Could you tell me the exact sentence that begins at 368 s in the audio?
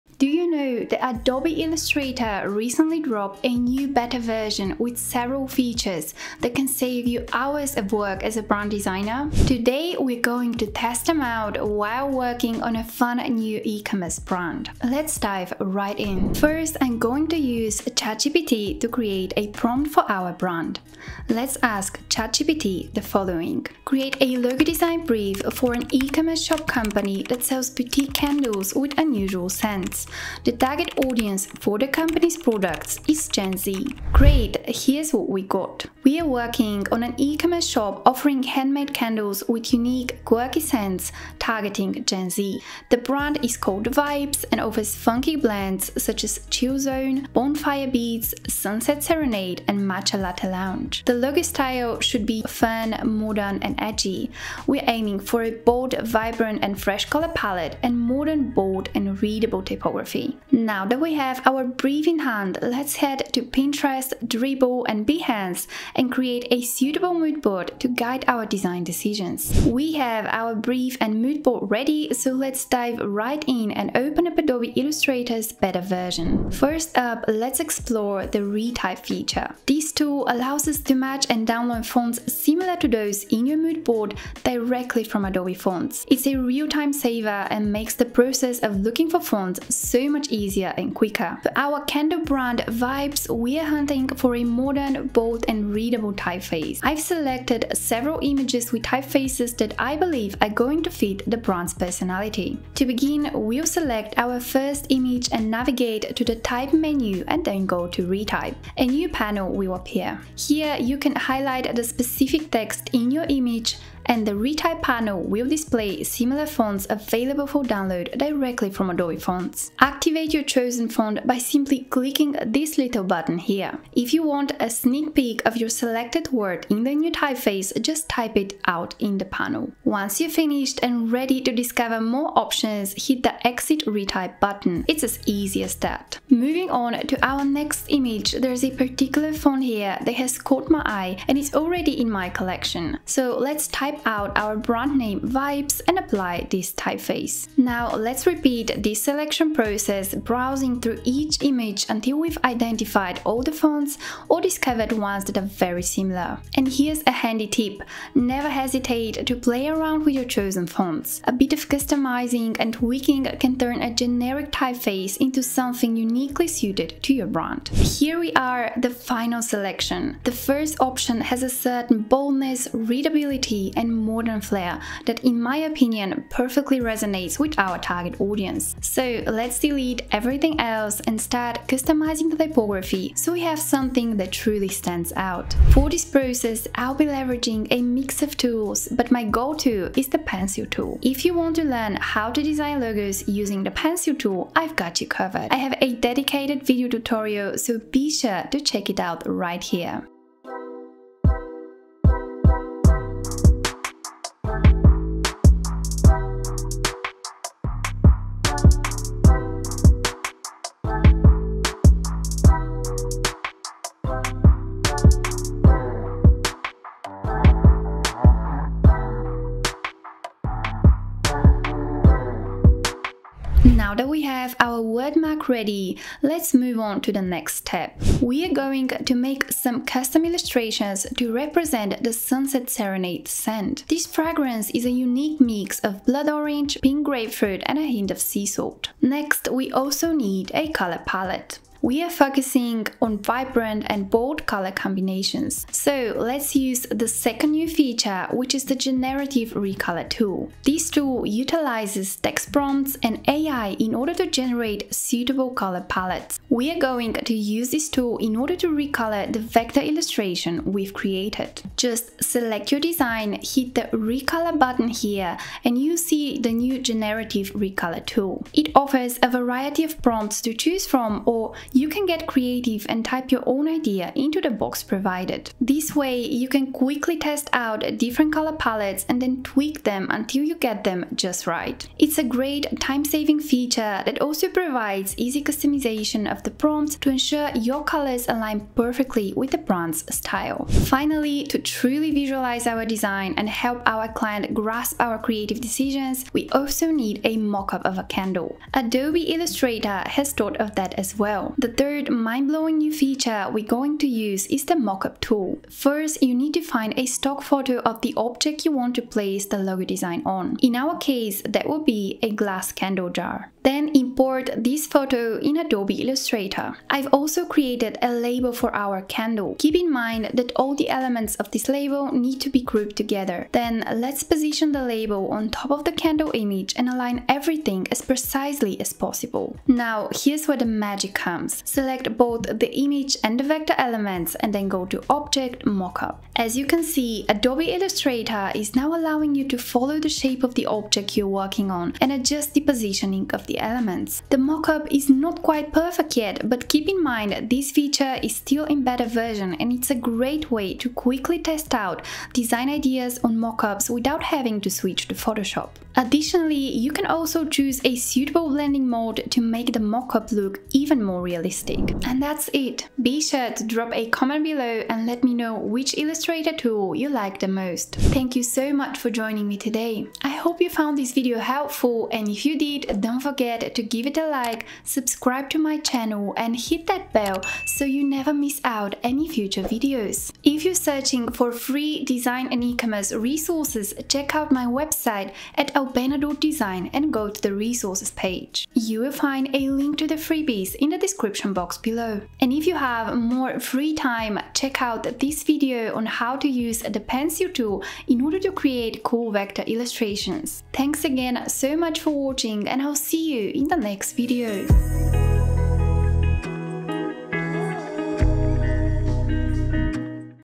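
Thank you so much for joining me today.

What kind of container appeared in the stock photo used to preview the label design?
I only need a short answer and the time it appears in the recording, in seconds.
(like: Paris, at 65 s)
glass candle jar, at 312 s.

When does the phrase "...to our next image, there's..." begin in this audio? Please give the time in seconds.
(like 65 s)
137 s.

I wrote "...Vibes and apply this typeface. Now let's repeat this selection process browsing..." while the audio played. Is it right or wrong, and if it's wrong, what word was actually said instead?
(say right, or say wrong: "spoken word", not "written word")
right.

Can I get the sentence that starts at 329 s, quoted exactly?
Now here's where the magic comes.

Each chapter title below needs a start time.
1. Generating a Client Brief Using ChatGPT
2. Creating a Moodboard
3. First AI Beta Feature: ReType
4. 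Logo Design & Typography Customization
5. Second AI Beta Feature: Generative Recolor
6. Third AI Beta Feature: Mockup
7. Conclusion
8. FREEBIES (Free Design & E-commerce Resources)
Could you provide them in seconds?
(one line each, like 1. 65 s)
1. 17 s
2. 61 s
3. 76 s
4. 168 s
5. 228 s
6. 291 s
7. 362 s
8. 381 s.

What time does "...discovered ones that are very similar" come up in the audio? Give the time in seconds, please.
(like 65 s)
154 s.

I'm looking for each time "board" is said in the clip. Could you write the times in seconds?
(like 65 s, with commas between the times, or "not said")
67 s, 71 s, 83 s.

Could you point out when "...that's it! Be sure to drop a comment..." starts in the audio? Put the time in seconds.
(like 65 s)
362 s.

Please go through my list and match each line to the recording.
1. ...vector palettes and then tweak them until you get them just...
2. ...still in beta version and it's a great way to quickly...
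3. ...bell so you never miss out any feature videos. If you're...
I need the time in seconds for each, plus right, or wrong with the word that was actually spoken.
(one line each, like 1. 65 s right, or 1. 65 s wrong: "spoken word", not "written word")
1. 278 s wrong: "color", not "vector"
2. 348 s right
3. 377 s wrong: "future", not "feature".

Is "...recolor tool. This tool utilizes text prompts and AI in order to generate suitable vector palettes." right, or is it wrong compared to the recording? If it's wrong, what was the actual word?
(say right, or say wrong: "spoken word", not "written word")
wrong: "color", not "vector".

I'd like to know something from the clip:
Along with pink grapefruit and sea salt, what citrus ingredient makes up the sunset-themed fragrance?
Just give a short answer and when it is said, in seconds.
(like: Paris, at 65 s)
blood orange, at 236 s.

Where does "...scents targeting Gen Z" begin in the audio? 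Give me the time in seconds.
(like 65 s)
40 s.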